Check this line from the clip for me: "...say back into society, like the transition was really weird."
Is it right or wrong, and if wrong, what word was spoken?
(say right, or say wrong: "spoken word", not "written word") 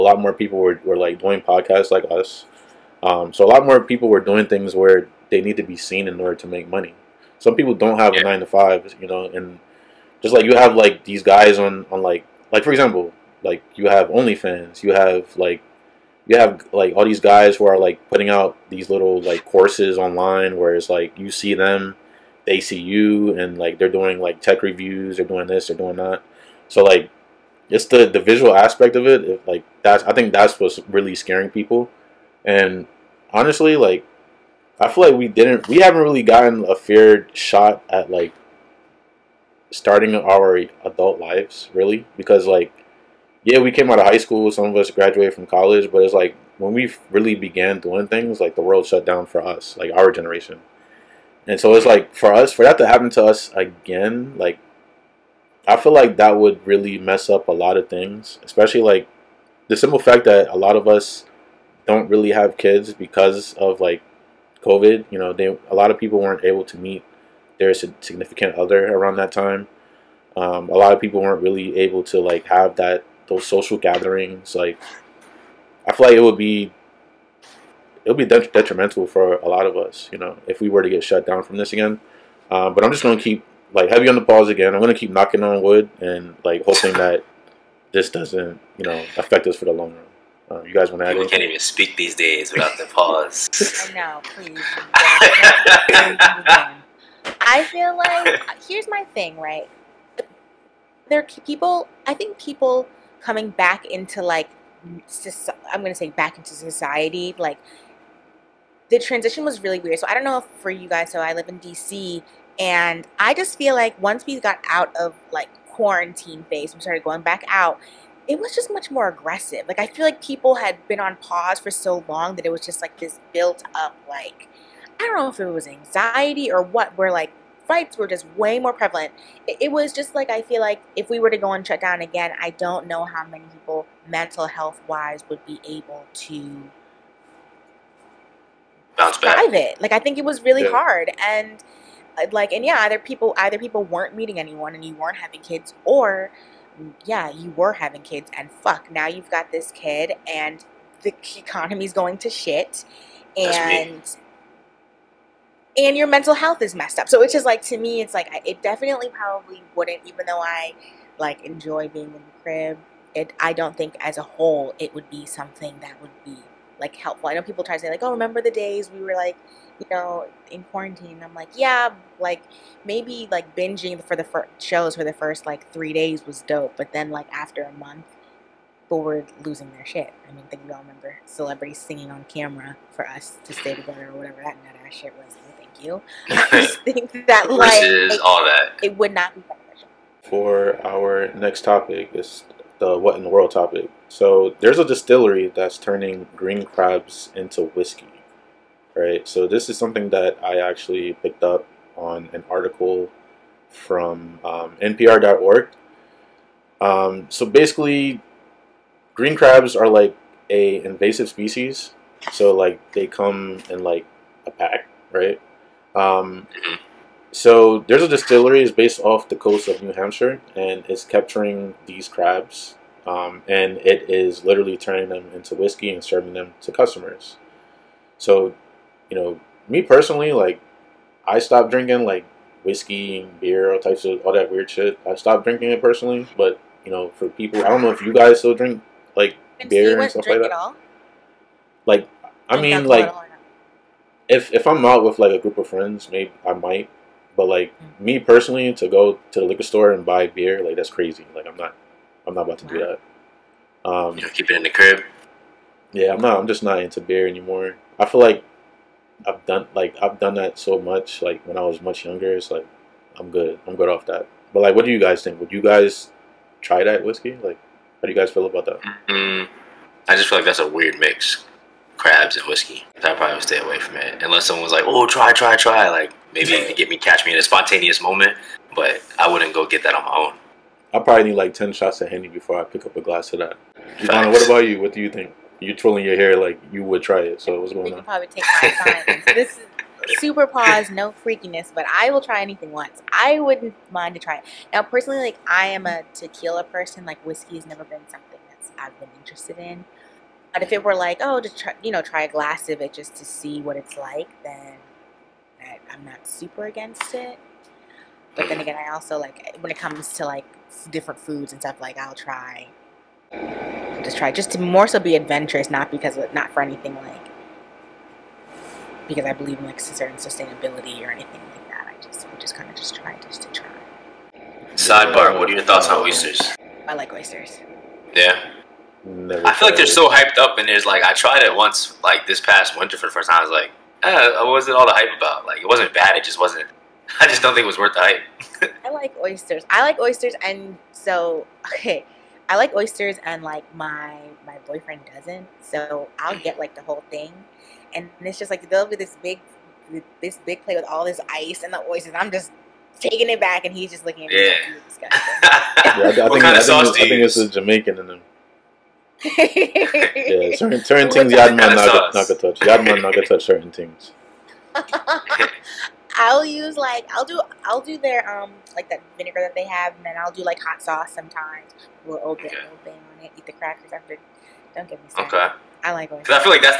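right.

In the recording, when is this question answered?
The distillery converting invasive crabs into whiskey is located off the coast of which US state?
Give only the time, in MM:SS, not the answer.
03:39.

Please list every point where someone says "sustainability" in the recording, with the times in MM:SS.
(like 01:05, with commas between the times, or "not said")
05:20.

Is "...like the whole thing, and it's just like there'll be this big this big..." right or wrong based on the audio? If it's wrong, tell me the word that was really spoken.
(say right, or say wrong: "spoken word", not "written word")
right.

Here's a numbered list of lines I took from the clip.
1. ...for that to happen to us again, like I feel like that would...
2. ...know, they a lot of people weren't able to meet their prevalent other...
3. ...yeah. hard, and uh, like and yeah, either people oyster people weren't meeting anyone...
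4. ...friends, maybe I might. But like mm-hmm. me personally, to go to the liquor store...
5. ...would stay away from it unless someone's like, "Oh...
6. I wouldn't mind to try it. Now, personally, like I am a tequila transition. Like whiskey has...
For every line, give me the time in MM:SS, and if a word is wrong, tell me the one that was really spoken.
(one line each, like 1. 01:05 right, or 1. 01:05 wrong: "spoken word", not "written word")
1. 00:52 right
2. 01:05 wrong: "significant", not "prevalent"
3. 02:20 wrong: "either", not "oyster"
4. 04:05 right
5. 04:33 right
6. 04:53 wrong: "person", not "transition".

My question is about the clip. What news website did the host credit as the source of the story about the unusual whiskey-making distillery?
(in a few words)
NPR.org.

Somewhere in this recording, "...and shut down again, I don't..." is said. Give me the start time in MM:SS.
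02:11.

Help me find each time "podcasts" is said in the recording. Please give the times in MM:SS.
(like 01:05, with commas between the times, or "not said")
00:01.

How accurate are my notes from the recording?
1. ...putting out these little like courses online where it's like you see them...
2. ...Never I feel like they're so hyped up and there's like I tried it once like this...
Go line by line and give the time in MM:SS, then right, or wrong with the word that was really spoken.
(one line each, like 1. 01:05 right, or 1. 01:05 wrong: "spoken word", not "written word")
1. 00:18 right
2. 05:29 right.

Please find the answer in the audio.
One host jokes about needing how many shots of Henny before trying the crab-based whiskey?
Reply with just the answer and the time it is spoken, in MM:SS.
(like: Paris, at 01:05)
10, at 04:41.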